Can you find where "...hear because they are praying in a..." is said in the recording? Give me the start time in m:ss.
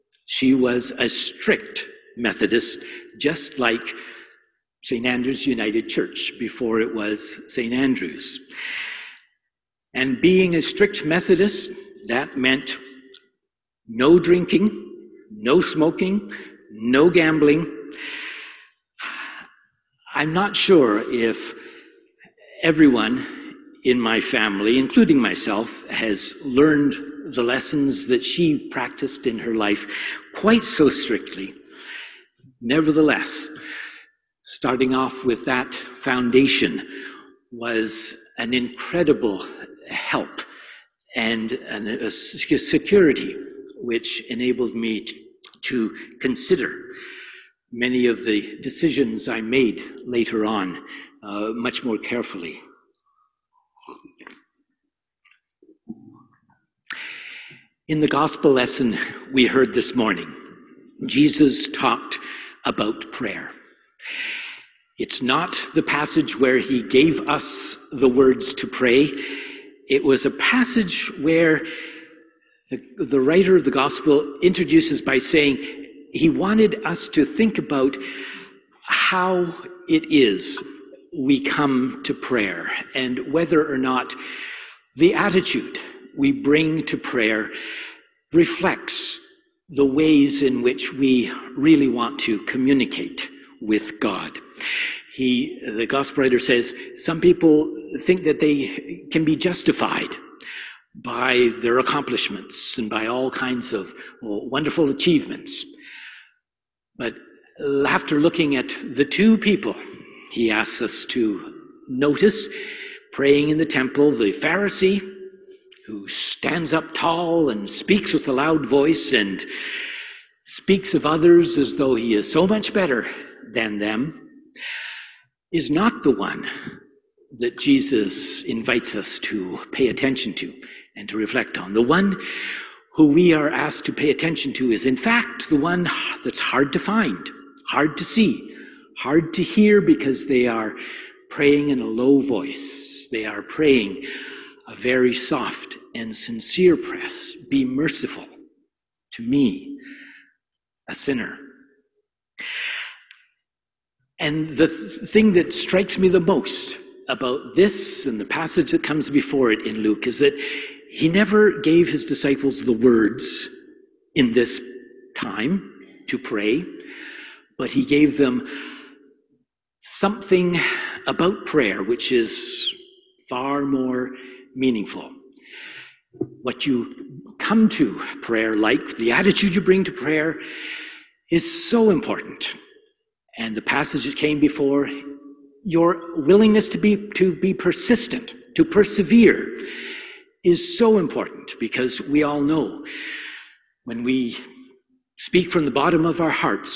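2:19.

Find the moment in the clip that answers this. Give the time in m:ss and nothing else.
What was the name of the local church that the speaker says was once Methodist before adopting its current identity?
0:04.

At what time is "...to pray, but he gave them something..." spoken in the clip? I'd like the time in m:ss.
2:46.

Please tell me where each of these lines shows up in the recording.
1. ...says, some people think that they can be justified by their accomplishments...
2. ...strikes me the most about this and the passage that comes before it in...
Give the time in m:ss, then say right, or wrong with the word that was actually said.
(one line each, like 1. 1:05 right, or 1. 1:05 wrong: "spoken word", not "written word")
1. 1:36 right
2. 2:35 right.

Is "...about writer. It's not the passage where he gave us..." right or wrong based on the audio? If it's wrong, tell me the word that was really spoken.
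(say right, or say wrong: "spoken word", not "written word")
wrong: "prayer", not "writer".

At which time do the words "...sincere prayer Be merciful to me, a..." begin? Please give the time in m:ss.
2:26.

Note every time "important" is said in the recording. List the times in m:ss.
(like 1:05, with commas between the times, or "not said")
3:01, 3:10.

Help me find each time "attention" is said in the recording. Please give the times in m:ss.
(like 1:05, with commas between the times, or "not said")
2:09, 2:14.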